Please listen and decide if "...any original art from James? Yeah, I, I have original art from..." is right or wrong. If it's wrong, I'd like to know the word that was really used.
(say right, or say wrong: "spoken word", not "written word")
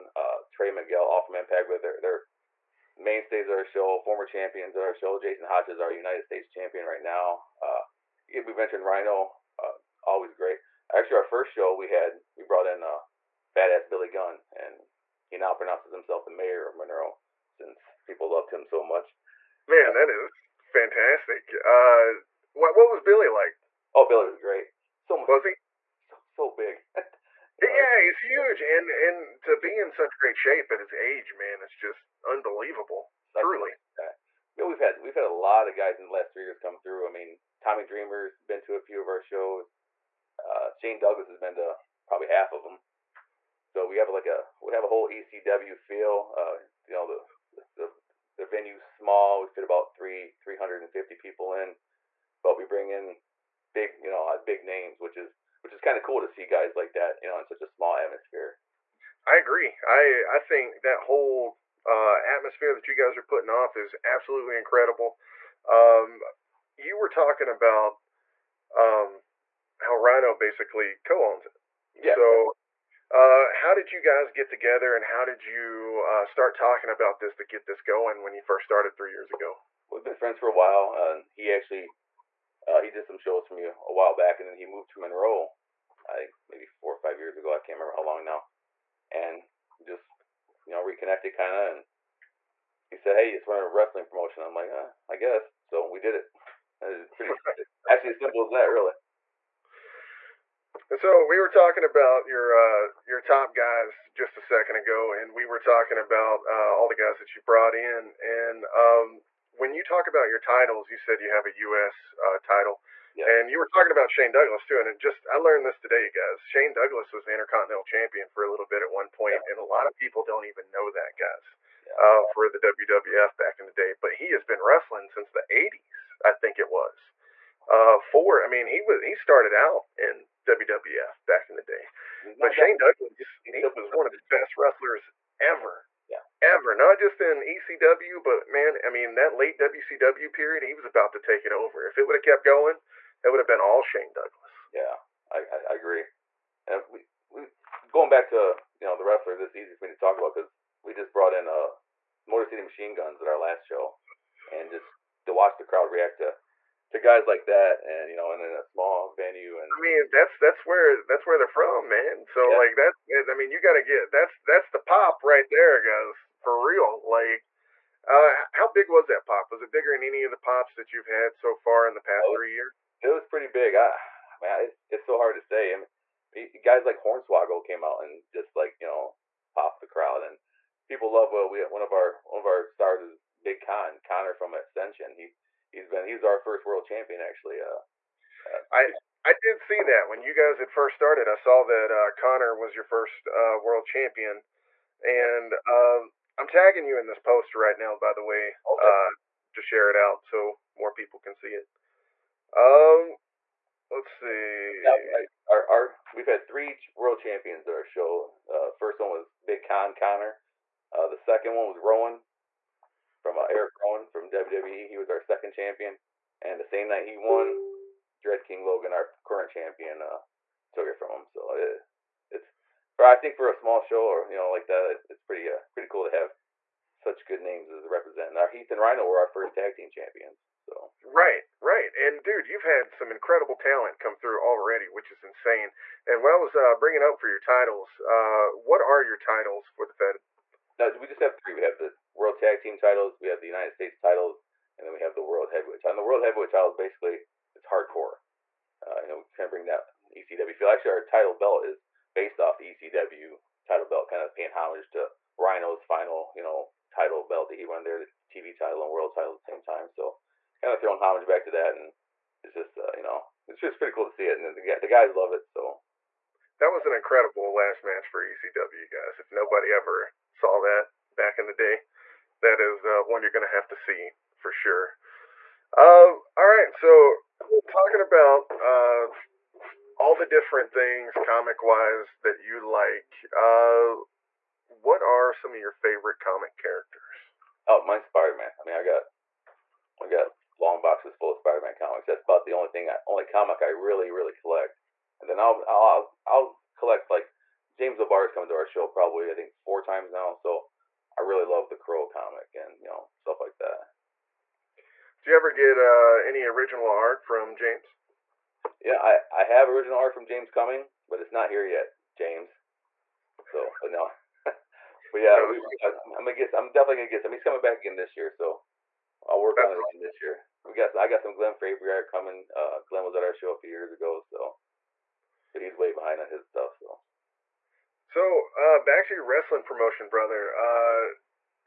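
right.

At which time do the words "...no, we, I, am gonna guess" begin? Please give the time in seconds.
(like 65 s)
315 s.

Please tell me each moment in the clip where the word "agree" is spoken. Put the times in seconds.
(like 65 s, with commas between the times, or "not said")
59 s, 145 s.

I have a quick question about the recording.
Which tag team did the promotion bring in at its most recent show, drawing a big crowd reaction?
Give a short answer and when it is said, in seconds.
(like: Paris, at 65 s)
Motor City Machine Guns, at 152 s.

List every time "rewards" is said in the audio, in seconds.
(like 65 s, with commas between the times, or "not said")
not said.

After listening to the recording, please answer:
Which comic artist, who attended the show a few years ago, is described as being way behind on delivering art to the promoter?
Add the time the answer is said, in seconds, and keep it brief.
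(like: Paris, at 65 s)
Glenn Fabry, at 321 s.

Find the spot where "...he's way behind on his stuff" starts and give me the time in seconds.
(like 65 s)
325 s.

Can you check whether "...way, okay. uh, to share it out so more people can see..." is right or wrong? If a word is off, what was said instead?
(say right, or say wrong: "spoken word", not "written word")
right.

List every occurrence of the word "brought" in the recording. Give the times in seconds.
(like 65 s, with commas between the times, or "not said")
12 s, 107 s, 151 s.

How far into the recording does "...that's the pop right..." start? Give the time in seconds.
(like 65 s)
164 s.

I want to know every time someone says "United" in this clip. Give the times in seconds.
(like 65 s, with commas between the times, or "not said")
5 s, 243 s.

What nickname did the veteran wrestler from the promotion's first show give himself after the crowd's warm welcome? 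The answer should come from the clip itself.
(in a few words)
Mayor of Monroe.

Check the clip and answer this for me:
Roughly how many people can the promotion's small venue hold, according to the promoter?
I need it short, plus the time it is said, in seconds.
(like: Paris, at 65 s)
350, at 50 s.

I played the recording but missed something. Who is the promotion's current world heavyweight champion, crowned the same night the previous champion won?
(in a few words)
Dread King Logan.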